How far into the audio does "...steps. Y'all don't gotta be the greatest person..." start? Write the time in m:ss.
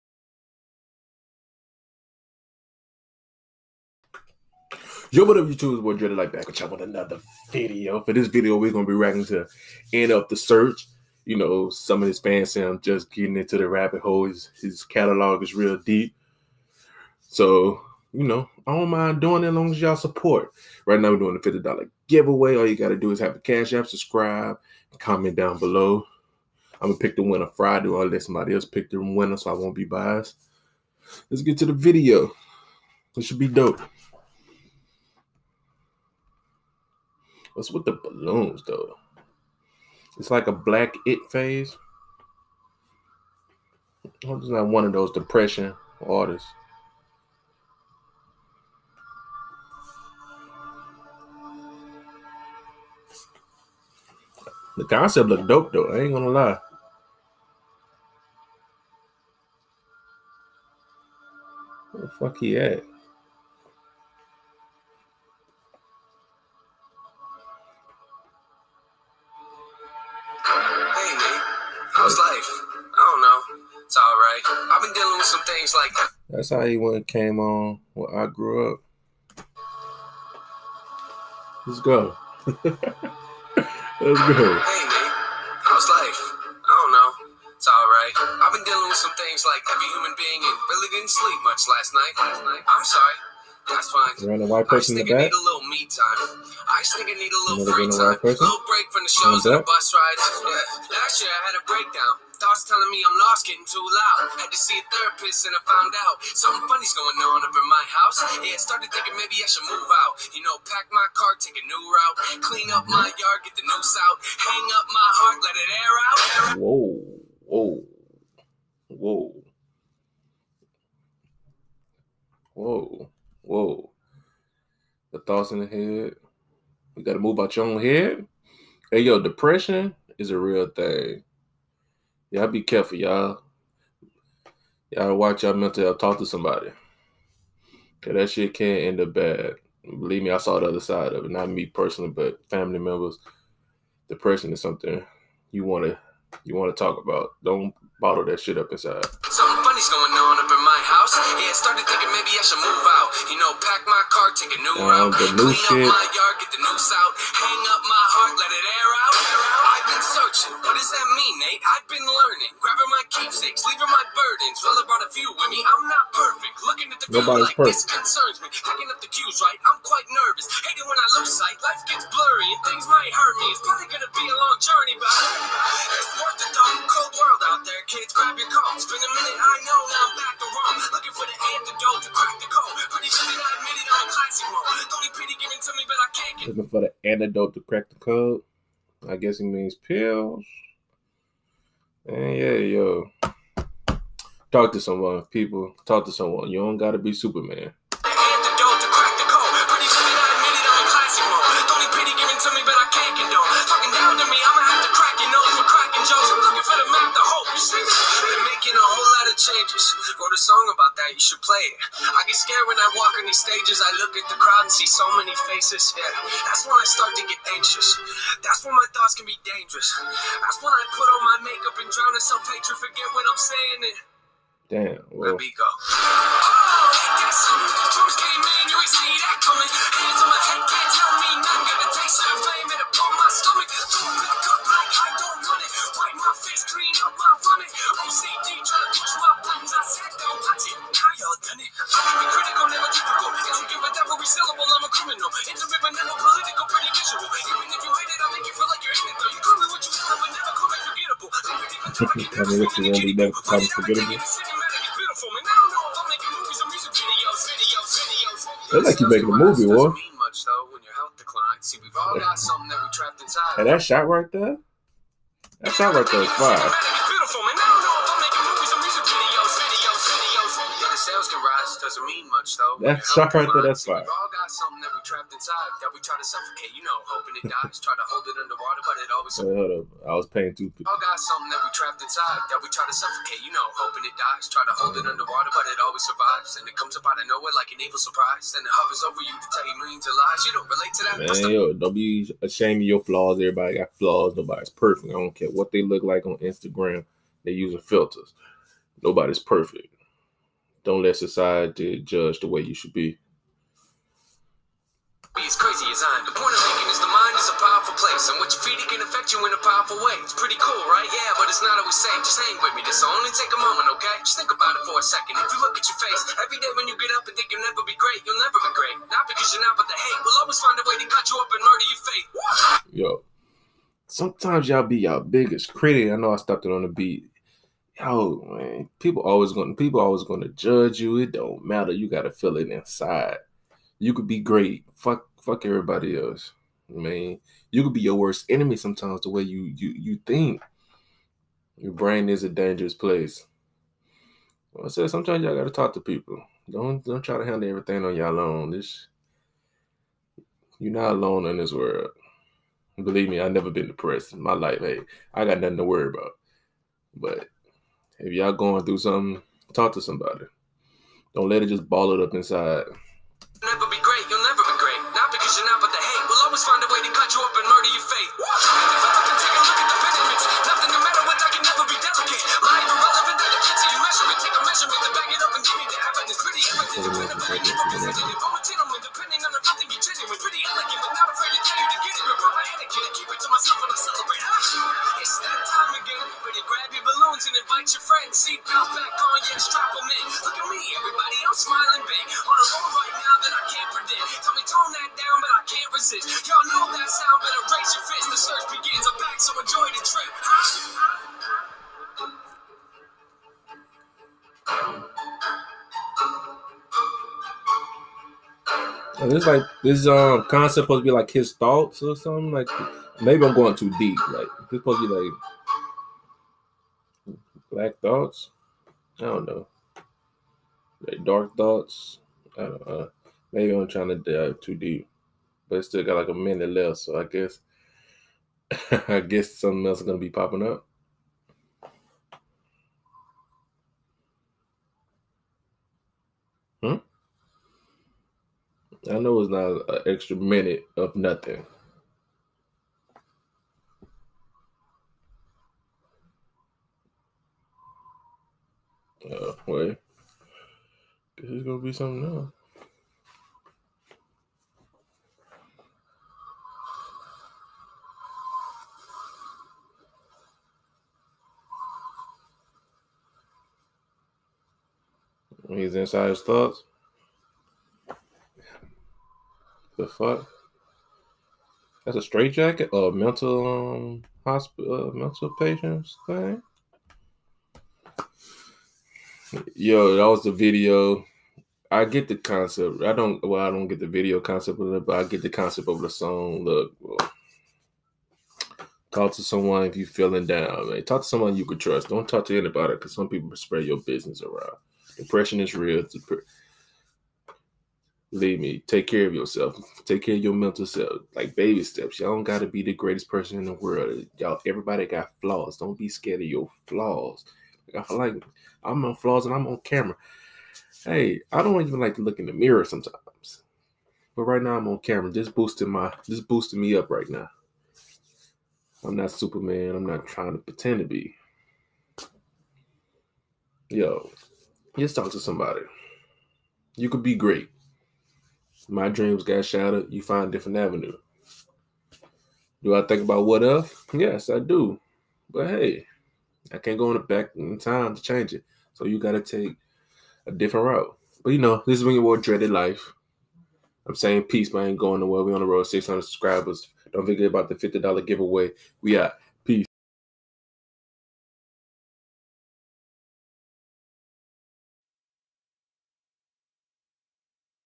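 8:21.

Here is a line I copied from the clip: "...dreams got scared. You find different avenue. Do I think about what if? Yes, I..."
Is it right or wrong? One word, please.
wrong.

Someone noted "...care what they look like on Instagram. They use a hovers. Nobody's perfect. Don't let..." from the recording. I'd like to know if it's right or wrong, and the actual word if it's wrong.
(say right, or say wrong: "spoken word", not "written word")
wrong: "filters", not "hovers".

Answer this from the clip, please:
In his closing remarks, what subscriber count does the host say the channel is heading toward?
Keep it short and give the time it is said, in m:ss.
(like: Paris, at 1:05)
600, at 9:05.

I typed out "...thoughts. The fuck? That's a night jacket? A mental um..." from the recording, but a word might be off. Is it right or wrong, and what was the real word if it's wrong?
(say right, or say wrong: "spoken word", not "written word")
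wrong: "straight", not "night".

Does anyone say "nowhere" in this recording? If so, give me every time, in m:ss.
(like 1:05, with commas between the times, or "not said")
4:47, 9:05.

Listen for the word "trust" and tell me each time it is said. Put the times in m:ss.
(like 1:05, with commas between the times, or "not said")
8:11.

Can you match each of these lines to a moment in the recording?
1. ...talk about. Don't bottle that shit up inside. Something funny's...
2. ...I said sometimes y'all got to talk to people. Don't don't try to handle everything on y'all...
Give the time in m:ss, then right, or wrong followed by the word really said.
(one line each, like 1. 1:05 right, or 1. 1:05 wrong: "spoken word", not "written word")
1. 2:26 right
2. 5:44 right.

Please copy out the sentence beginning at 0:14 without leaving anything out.
His, his catalog is real deep.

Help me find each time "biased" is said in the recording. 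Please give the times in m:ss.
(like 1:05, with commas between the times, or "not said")
0:29.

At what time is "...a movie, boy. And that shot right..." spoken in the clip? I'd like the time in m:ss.
4:19.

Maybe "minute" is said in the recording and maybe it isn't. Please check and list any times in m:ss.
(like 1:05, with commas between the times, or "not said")
7:06, 7:20.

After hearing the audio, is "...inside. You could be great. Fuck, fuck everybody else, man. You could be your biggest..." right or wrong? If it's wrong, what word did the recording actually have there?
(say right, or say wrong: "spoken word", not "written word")
wrong: "worst", not "biggest".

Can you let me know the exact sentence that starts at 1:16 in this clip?
That's how he went came on Where I grew up.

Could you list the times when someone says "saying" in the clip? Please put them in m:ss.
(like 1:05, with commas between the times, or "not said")
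3:43, 9:04.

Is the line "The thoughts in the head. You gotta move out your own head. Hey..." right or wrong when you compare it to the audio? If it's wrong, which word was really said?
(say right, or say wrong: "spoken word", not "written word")
right.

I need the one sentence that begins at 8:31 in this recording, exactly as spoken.
Hey, I don't even like to look in the mirror sometimes.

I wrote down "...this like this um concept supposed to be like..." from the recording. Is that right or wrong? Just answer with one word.
right.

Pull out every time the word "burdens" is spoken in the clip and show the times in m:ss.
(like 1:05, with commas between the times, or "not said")
2:44.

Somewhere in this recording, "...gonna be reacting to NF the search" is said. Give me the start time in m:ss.
0:08.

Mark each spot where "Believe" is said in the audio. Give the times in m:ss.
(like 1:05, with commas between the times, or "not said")
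2:19, 5:52.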